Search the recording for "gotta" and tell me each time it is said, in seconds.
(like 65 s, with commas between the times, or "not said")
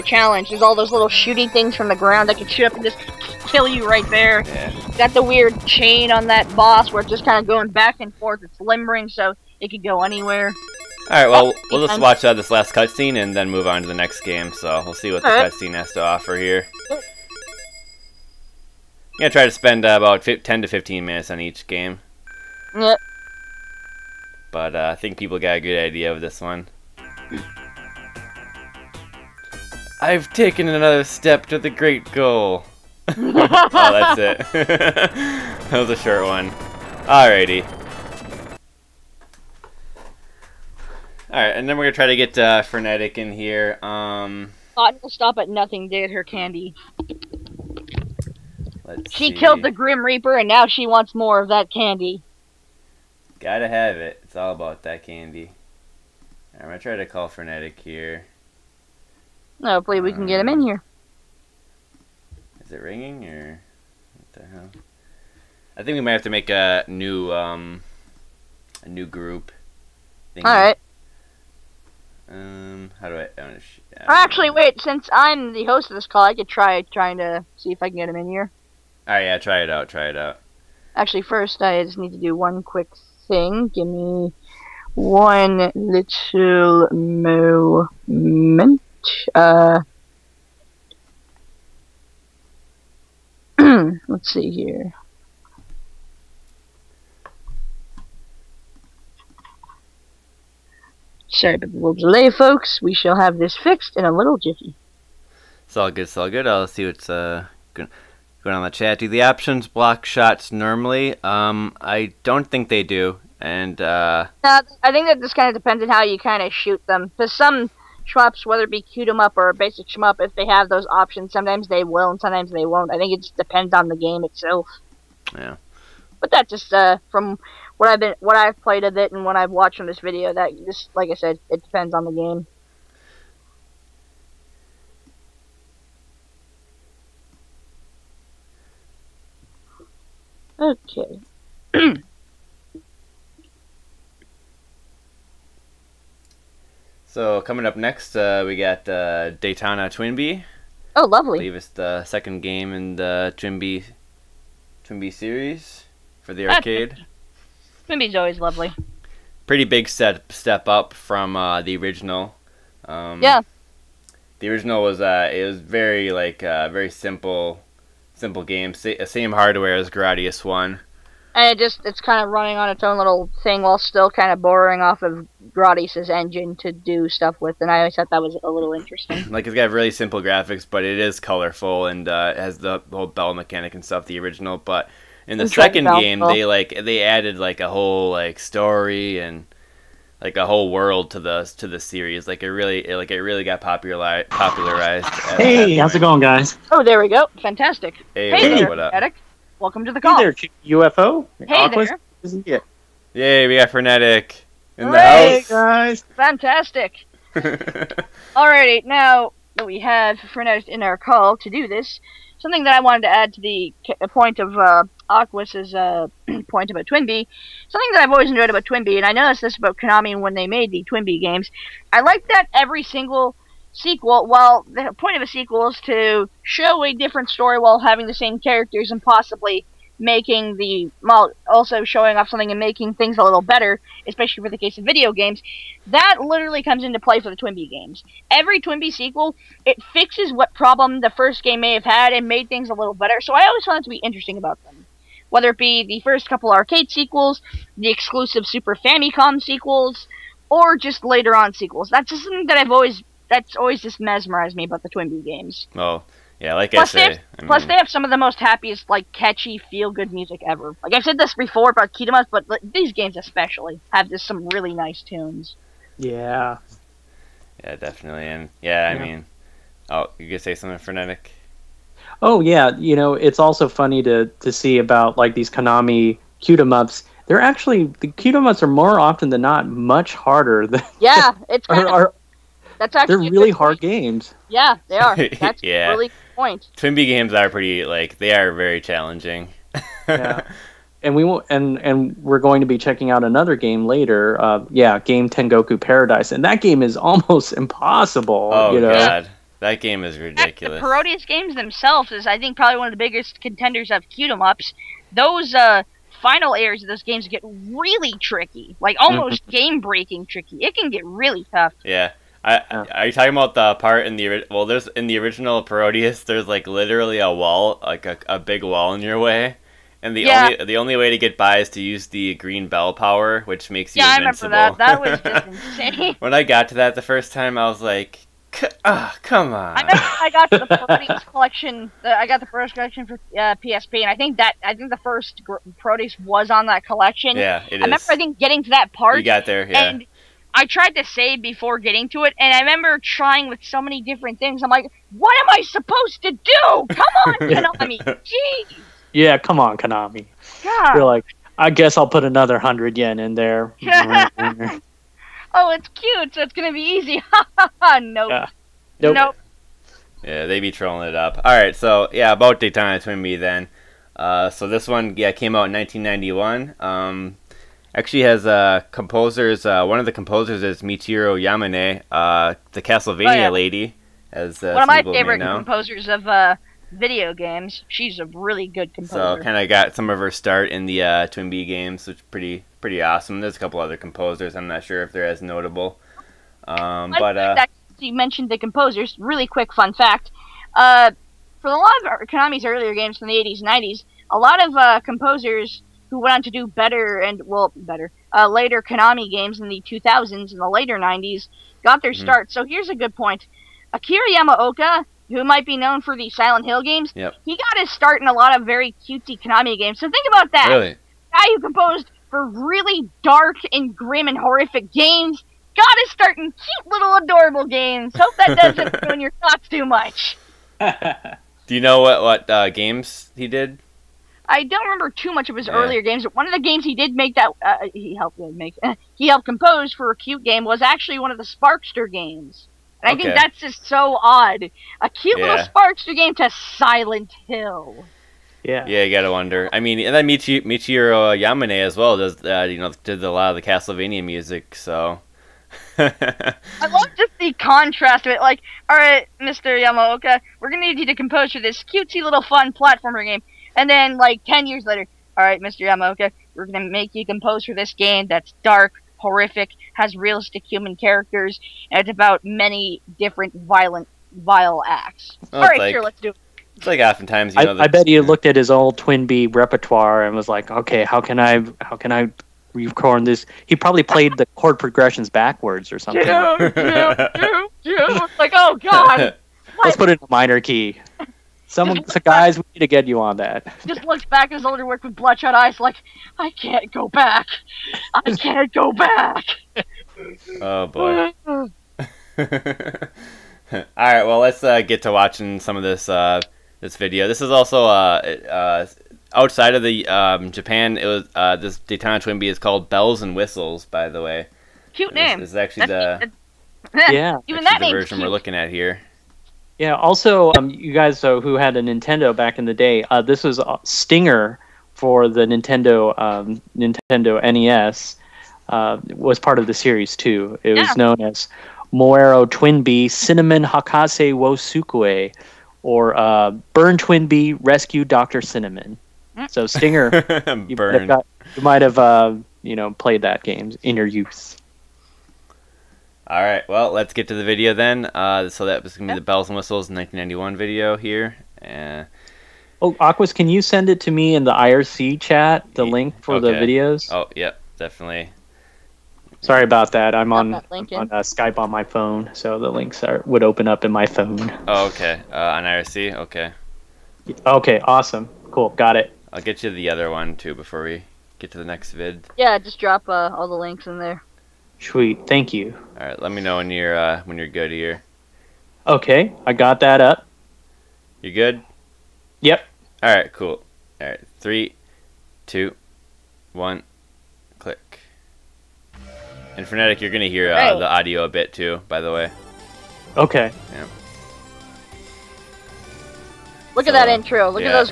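53 s, 439 s.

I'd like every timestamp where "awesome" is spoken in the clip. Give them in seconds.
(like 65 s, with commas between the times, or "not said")
383 s, 557 s.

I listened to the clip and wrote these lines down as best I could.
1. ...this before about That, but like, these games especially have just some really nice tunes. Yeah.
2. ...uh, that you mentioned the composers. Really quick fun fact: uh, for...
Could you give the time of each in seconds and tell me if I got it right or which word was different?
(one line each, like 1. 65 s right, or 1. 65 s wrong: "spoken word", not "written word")
1. 261 s wrong: "Kitamas", not "That"
2. 387 s right.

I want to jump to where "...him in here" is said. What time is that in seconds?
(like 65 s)
78 s.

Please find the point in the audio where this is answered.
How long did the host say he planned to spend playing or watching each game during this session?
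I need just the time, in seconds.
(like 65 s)
20 s.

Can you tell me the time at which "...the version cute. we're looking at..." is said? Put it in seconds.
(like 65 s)
507 s.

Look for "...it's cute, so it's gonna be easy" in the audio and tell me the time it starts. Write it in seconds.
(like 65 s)
355 s.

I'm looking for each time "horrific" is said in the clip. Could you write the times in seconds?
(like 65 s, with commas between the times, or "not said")
414 s, 459 s.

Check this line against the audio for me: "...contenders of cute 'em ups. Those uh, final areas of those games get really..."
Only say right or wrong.
right.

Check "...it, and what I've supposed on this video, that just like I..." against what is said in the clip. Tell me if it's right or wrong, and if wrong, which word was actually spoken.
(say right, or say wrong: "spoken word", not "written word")
wrong: "watched", not "supposed".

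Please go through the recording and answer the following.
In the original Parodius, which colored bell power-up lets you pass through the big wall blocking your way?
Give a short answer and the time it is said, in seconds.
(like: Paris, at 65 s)
green bell, at 322 s.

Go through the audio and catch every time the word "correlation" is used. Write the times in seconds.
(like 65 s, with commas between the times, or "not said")
not said.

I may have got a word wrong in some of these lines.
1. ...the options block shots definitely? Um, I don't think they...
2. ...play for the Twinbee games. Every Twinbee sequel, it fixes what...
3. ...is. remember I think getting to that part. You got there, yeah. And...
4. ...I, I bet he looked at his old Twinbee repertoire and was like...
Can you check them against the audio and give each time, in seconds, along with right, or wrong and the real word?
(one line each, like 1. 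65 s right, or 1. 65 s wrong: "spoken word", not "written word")
1. 109 s wrong: "normally", not "definitely"
2. 236 s right
3. 337 s right
4. 467 s right.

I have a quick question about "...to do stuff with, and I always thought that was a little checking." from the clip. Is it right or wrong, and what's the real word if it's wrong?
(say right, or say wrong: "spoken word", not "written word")
wrong: "interesting", not "checking".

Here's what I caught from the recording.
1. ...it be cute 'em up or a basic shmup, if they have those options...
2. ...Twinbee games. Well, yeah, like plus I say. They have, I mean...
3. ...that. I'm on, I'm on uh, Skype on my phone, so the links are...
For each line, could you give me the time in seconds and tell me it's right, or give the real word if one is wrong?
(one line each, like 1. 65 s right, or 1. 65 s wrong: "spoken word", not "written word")
1. 118 s right
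2. 254 s right
3. 549 s right.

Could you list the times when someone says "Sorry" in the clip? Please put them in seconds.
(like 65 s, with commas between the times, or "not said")
101 s, 549 s.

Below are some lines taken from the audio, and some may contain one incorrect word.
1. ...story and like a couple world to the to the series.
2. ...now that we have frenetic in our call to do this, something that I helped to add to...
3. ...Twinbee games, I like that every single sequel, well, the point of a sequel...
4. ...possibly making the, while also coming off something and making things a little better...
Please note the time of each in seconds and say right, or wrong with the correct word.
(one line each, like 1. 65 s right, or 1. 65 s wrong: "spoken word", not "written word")
1. 188 s wrong: "whole", not "couple"
2. 208 s wrong: "wanted", not "helped"
3. 220 s right
4. 229 s wrong: "showing", not "coming".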